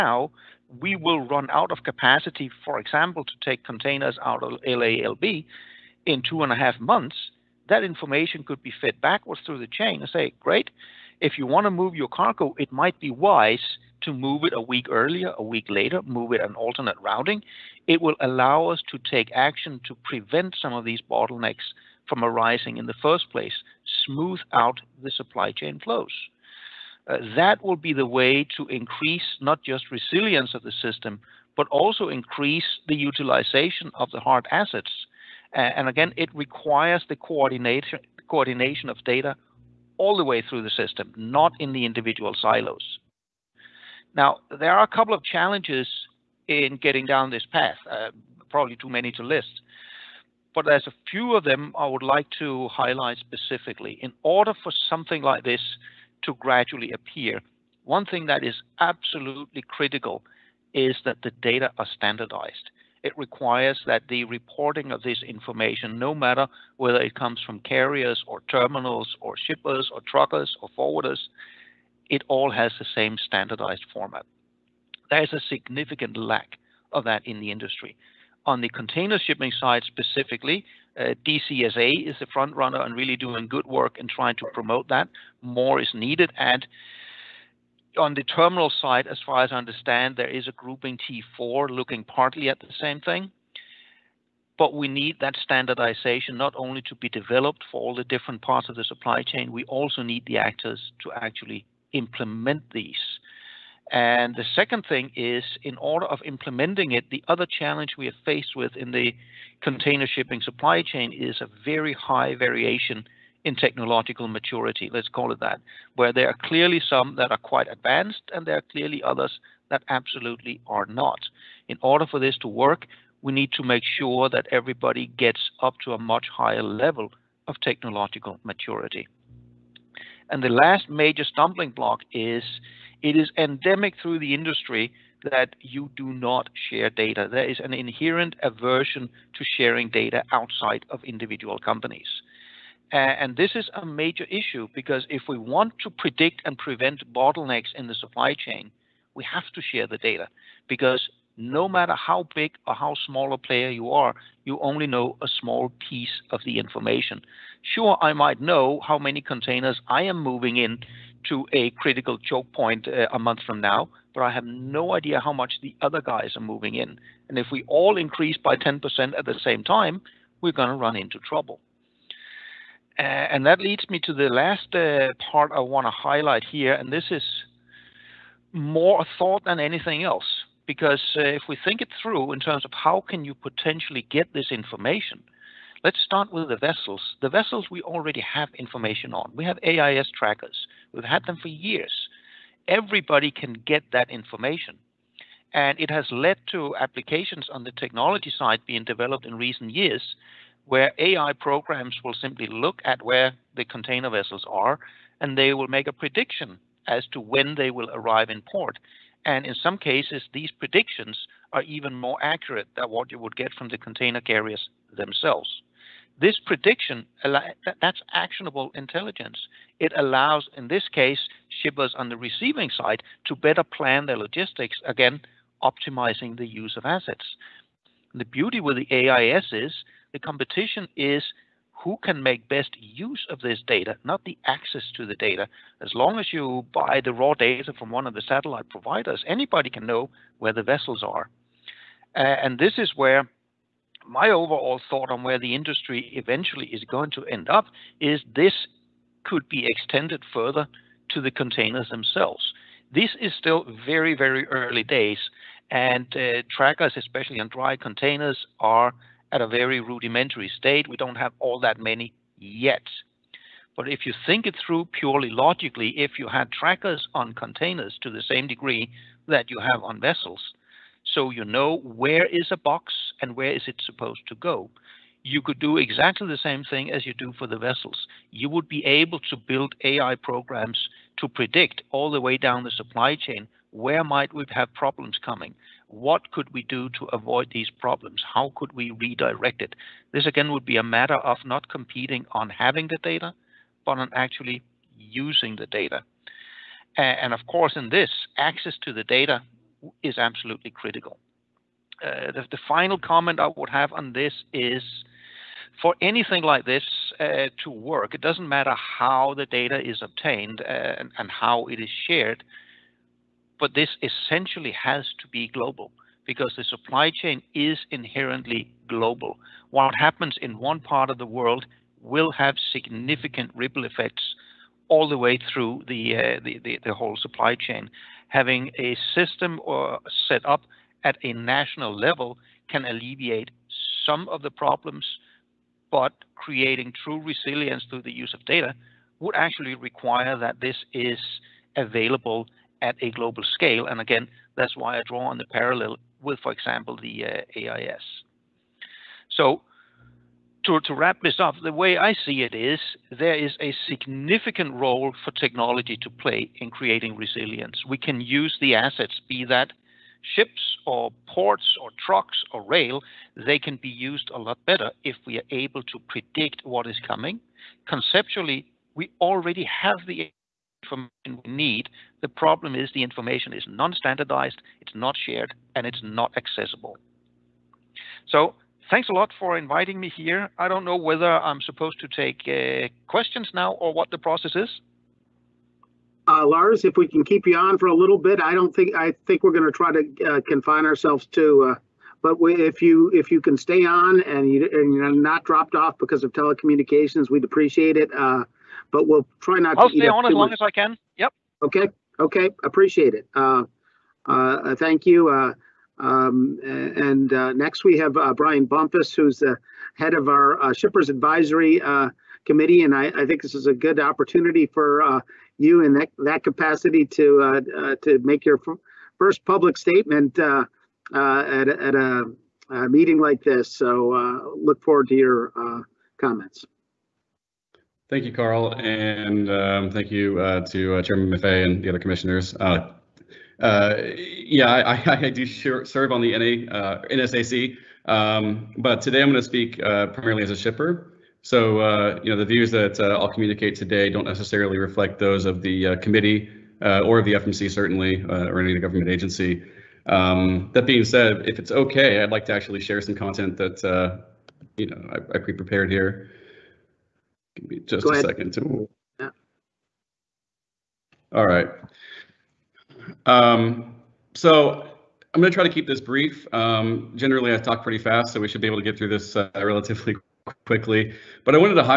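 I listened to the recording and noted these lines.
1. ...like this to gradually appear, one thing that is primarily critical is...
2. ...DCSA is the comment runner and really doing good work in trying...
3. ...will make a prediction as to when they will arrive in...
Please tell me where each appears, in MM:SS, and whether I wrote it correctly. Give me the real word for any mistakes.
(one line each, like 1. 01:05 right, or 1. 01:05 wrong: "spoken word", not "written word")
1. 00:55 wrong: "absolutely", not "primarily"
2. 01:21 wrong: "front", not "comment"
3. 03:25 right.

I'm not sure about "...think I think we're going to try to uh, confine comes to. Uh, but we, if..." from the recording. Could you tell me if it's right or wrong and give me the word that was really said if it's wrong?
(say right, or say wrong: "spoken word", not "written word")
wrong: "ourselves", not "comes".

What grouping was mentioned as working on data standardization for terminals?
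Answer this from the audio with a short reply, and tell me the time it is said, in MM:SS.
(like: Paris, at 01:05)
T4, at 01:30.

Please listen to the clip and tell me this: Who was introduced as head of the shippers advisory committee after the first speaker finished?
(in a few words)
Brian Bumpus.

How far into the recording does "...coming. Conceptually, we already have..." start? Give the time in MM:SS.
06:07.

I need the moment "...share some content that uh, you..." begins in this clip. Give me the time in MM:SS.
07:32.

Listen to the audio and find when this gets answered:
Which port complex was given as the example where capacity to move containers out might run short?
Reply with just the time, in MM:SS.
00:04.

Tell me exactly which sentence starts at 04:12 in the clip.
This is still very, very early days, and uh, trackers, especially on dry containers, are at a very rudimentary state.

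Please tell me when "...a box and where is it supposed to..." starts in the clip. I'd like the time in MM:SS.
04:32.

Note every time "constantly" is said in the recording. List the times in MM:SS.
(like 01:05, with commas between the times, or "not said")
not said.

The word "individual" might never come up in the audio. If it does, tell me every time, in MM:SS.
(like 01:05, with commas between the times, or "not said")
00:41, 02:21.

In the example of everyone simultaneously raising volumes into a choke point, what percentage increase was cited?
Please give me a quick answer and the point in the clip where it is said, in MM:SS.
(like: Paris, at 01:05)
10%, at 02:48.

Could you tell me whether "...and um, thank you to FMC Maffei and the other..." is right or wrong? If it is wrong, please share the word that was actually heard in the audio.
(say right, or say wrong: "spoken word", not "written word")
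wrong: "Chairman", not "FMC".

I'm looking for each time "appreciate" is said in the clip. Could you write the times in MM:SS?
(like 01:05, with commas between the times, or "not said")
06:37, 06:42.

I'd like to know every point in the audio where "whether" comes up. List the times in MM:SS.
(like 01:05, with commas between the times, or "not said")
01:06, 06:20.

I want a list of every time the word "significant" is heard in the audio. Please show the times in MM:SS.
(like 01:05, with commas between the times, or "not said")
01:15, 05:22, 05:53.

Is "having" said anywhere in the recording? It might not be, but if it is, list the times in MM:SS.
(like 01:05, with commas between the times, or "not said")
04:52, 05:28.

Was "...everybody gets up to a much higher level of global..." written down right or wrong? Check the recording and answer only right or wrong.
wrong.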